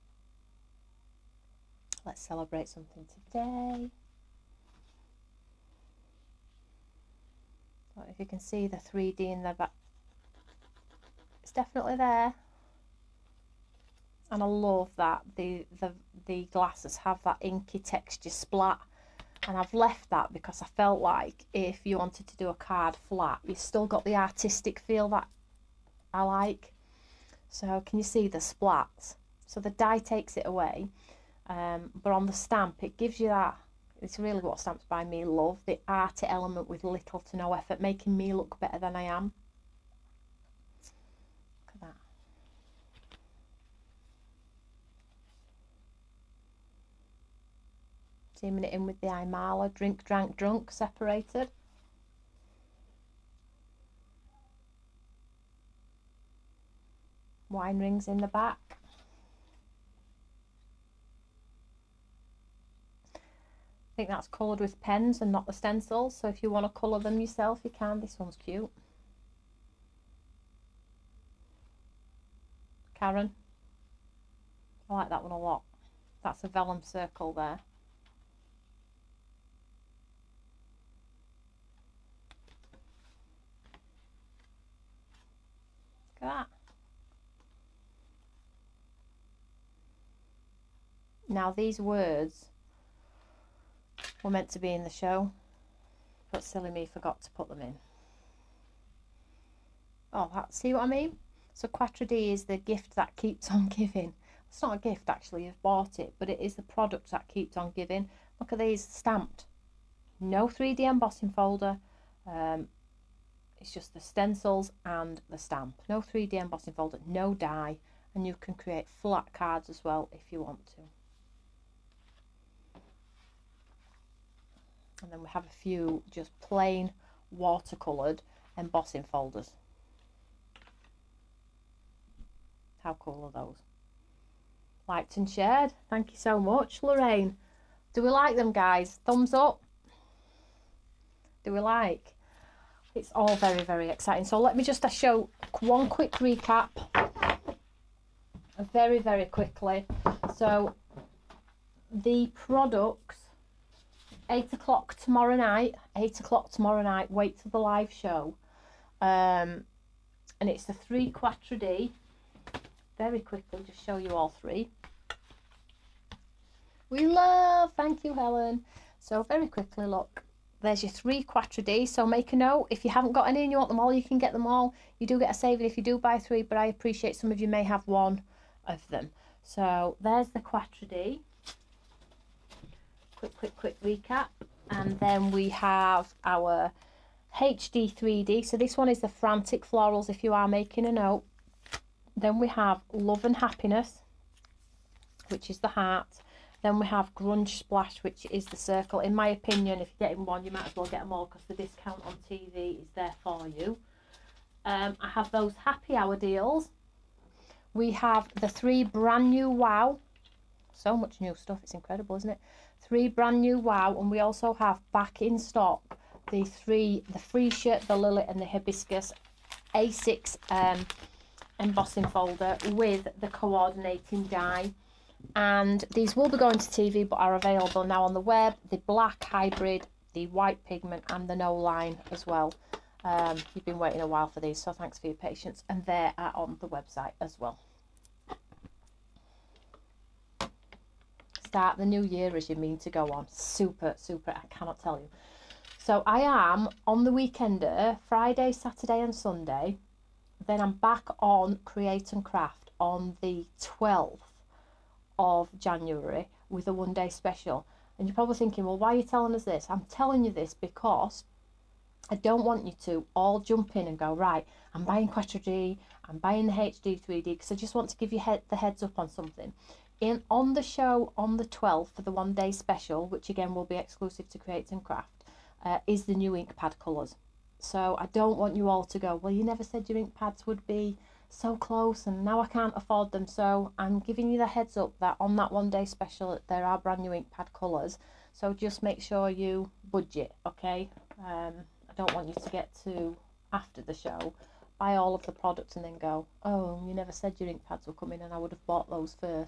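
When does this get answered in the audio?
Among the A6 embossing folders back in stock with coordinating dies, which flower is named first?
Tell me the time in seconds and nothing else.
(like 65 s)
217 s.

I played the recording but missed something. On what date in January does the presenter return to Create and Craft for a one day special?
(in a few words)
12th of January.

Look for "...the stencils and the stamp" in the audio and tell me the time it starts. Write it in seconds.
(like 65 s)
113 s.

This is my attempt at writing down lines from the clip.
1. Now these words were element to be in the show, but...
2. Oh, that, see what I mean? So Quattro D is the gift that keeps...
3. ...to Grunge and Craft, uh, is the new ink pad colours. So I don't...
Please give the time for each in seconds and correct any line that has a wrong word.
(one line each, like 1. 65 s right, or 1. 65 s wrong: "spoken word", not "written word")
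1. 91 s wrong: "meant", not "element"
2. 100 s right
3. 274 s wrong: "Create", not "Grunge".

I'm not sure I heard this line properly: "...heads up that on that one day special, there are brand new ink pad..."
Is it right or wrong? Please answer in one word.
right.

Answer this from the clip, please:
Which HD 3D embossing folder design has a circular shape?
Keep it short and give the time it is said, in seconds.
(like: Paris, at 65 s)
Grunge Splash, at 197 s.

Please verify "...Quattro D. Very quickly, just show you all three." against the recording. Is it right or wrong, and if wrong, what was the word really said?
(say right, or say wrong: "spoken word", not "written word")
right.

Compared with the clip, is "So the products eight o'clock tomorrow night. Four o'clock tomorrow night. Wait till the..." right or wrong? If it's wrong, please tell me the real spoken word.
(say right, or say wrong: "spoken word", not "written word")
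wrong: "Eight", not "Four".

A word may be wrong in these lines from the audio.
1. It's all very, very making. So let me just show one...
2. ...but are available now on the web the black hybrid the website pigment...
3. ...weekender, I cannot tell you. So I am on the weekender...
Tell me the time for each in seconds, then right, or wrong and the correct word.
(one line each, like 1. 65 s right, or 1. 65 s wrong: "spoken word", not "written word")
1. 142 s wrong: "exciting", not "making"
2. 227 s wrong: "white", not "website"
3. 243 s wrong: "super", not "weekender".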